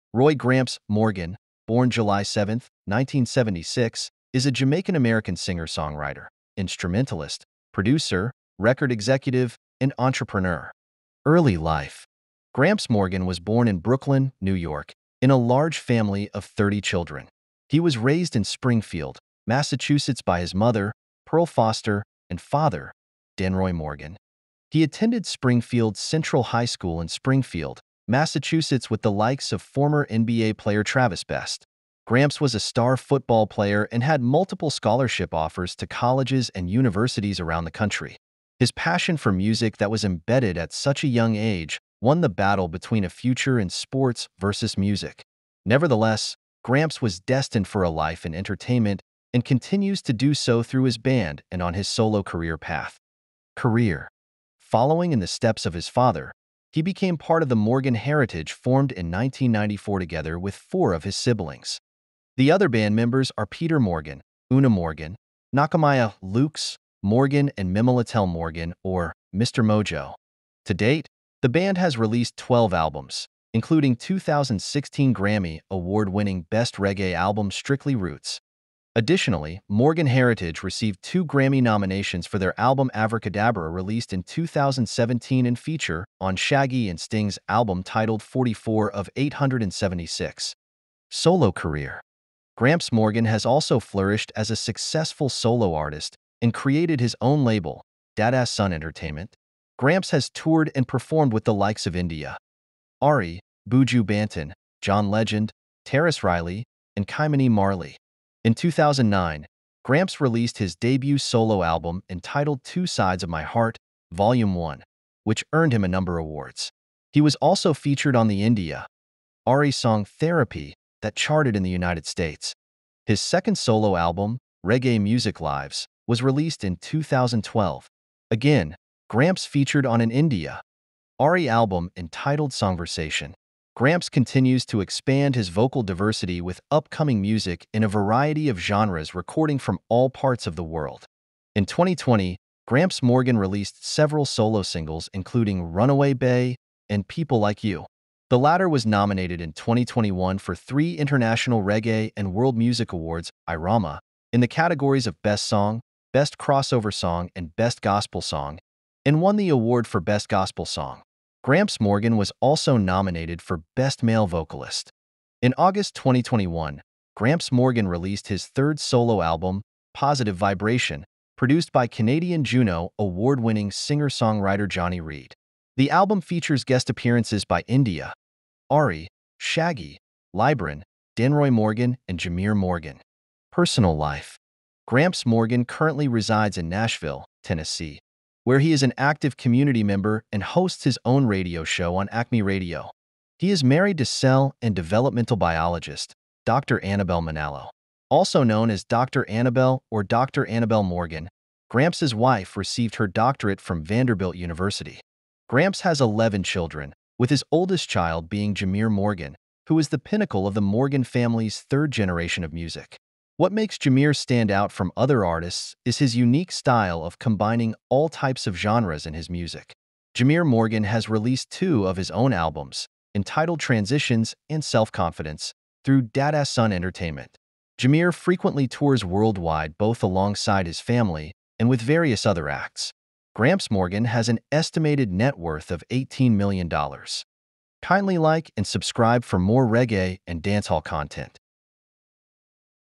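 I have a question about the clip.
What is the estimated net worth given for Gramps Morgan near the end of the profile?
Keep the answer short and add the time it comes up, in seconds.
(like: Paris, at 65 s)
$18 million, at 235 s.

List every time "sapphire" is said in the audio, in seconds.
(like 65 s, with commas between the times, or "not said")
not said.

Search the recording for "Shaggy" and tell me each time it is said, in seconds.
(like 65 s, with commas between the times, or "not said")
86 s, 179 s.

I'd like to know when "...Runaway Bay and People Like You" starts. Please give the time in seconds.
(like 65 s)
145 s.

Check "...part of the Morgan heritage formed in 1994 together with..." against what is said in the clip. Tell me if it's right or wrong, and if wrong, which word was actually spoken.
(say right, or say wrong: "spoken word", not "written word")
right.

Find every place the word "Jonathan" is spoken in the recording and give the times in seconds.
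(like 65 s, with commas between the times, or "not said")
not said.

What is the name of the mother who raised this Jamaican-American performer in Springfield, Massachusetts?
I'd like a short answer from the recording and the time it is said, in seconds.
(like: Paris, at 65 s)
Pearl Foster, at 21 s.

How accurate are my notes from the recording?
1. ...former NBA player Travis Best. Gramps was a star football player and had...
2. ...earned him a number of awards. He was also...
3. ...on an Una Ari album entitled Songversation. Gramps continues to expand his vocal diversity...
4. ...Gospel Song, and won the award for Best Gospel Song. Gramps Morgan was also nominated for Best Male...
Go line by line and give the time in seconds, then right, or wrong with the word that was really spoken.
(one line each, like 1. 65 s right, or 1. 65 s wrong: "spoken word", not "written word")
1. 29 s right
2. 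115 s right
3. 129 s wrong: "India", not "Una"
4. 157 s right.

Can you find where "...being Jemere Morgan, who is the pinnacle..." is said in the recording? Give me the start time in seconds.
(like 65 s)
208 s.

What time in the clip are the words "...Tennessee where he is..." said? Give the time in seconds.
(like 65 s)
187 s.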